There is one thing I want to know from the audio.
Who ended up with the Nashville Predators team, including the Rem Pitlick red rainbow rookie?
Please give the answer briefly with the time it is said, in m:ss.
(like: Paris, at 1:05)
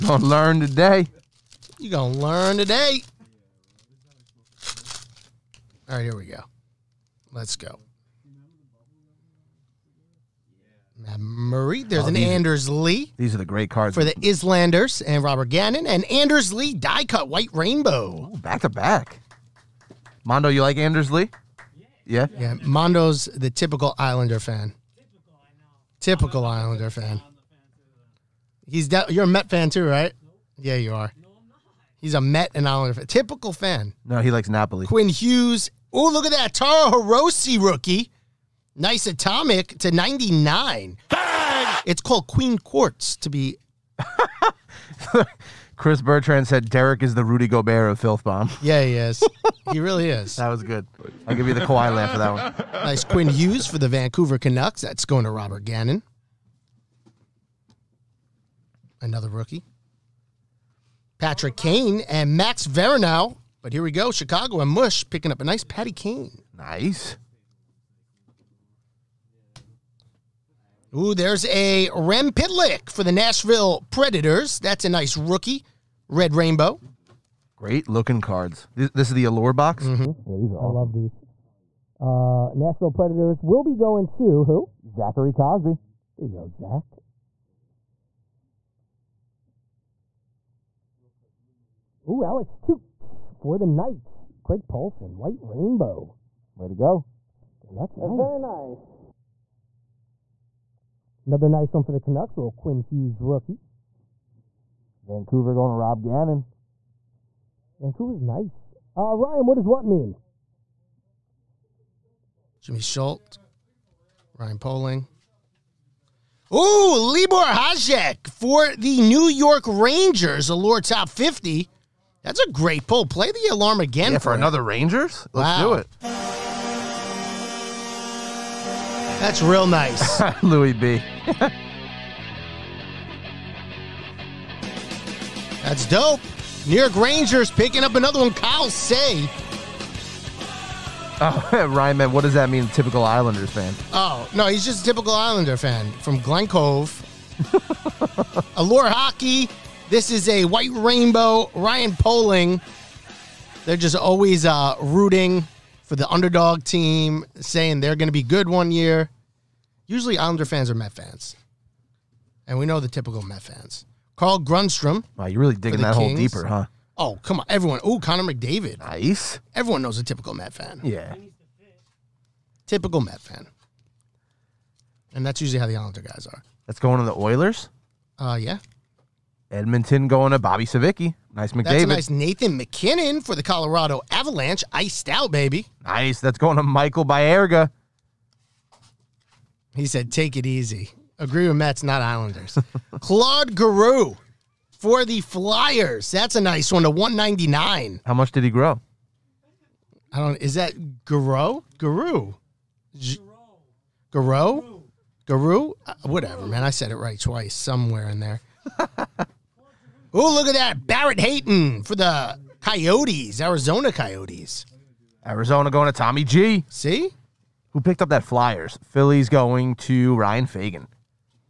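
Zachary Cosby, at 1:24.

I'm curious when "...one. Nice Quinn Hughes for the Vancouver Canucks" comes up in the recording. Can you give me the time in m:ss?
0:52.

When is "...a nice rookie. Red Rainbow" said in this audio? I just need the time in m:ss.
1:14.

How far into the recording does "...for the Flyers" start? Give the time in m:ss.
3:14.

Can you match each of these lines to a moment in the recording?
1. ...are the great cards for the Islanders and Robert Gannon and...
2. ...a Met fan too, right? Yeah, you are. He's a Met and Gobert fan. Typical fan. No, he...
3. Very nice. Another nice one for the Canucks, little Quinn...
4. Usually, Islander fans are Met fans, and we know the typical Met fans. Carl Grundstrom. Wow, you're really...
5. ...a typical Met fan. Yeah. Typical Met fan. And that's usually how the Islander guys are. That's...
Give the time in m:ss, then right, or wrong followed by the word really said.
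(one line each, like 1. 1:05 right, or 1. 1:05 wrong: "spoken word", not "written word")
1. 0:13 right
2. 0:29 wrong: "Islander", not "Gobert"
3. 1:38 right
4. 2:39 right
5. 2:49 right.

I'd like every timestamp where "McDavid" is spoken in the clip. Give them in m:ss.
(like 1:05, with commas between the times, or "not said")
2:48, 3:01.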